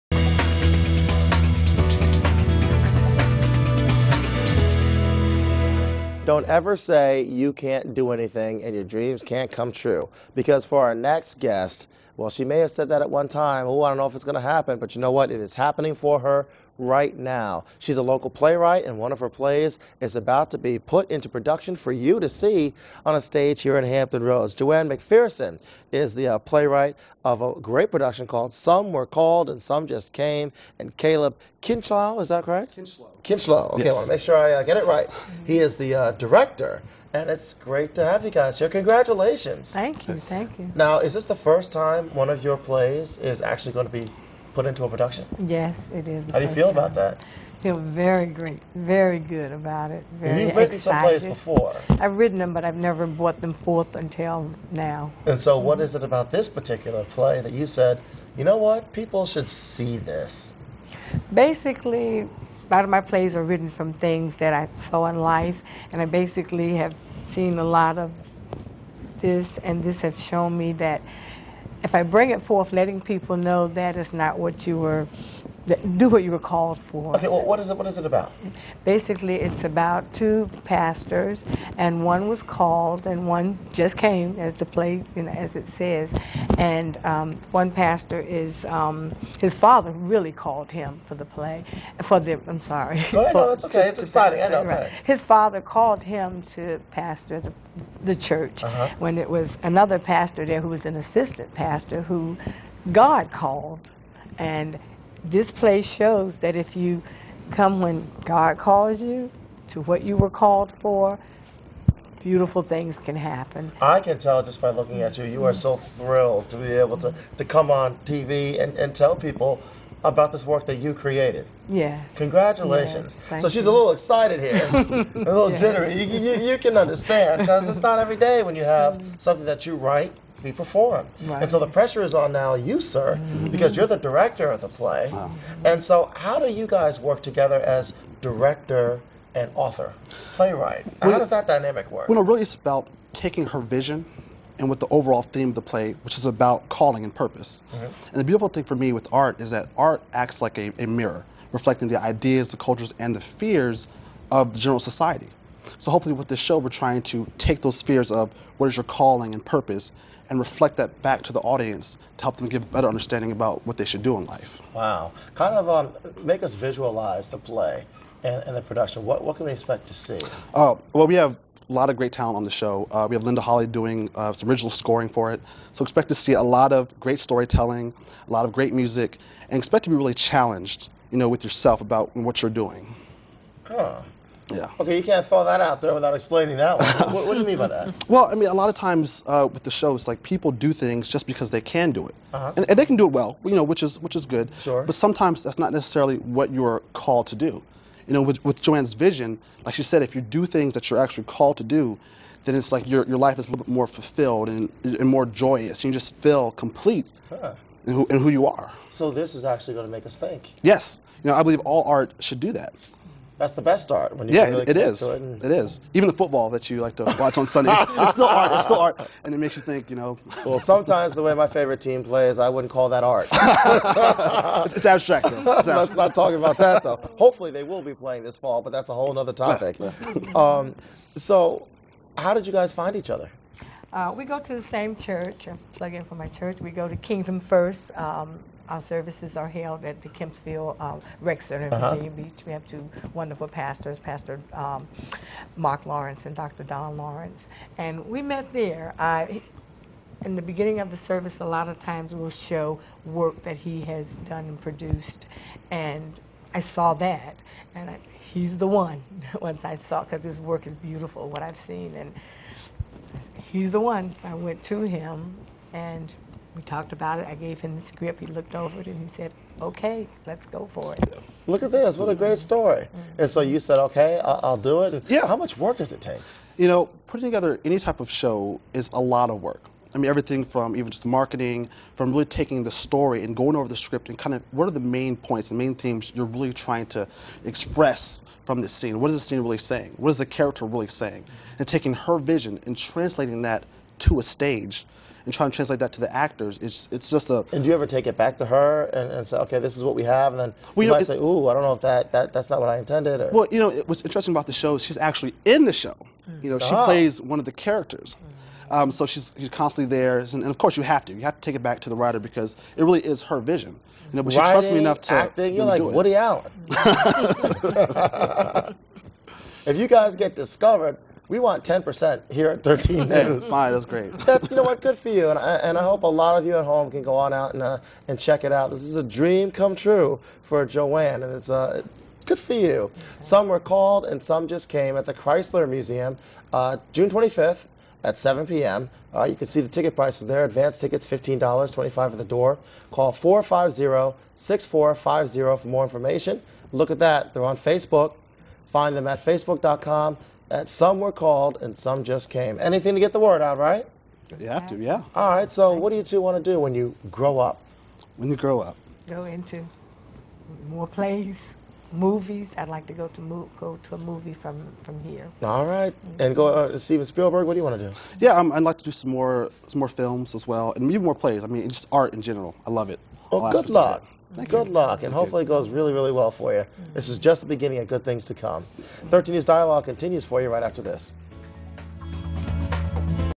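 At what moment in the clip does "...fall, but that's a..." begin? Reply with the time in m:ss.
3:48.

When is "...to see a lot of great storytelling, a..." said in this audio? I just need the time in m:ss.
2:56.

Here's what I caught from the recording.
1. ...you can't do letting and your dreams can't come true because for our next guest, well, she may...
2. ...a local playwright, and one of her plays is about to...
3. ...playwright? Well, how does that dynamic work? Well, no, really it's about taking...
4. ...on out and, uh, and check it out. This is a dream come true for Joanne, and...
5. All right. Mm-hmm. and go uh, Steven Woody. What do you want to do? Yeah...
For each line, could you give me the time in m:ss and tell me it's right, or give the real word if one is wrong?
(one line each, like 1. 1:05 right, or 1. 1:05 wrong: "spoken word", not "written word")
1. 0:07 wrong: "anything", not "letting"
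2. 0:17 right
3. 2:20 right
4. 5:27 right
5. 6:05 wrong: "Spielberg", not "Woody".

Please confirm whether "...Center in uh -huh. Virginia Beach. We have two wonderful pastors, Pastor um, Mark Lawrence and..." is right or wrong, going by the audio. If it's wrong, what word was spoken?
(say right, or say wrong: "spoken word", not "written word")
right.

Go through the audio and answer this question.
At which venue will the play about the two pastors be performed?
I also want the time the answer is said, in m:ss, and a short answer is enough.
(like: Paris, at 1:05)
The Chrysler Museum, at 5:35.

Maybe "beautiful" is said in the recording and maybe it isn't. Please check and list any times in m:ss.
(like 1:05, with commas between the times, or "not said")
1:52, 2:28, 4:20.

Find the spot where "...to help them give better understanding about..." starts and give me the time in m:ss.
2:42.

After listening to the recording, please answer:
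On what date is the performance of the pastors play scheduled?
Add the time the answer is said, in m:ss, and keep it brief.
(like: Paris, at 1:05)
June 25th, at 5:36.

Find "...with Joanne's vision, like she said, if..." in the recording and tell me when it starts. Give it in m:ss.
3:18.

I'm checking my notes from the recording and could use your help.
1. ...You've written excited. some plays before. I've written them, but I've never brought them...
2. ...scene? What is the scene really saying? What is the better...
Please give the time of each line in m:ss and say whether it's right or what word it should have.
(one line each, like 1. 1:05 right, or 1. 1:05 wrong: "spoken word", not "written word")
1. 0:50 right
2. 4:48 wrong: "character", not "better".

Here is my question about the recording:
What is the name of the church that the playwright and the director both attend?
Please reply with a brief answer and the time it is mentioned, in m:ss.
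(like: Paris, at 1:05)
Kingdom First, at 3:56.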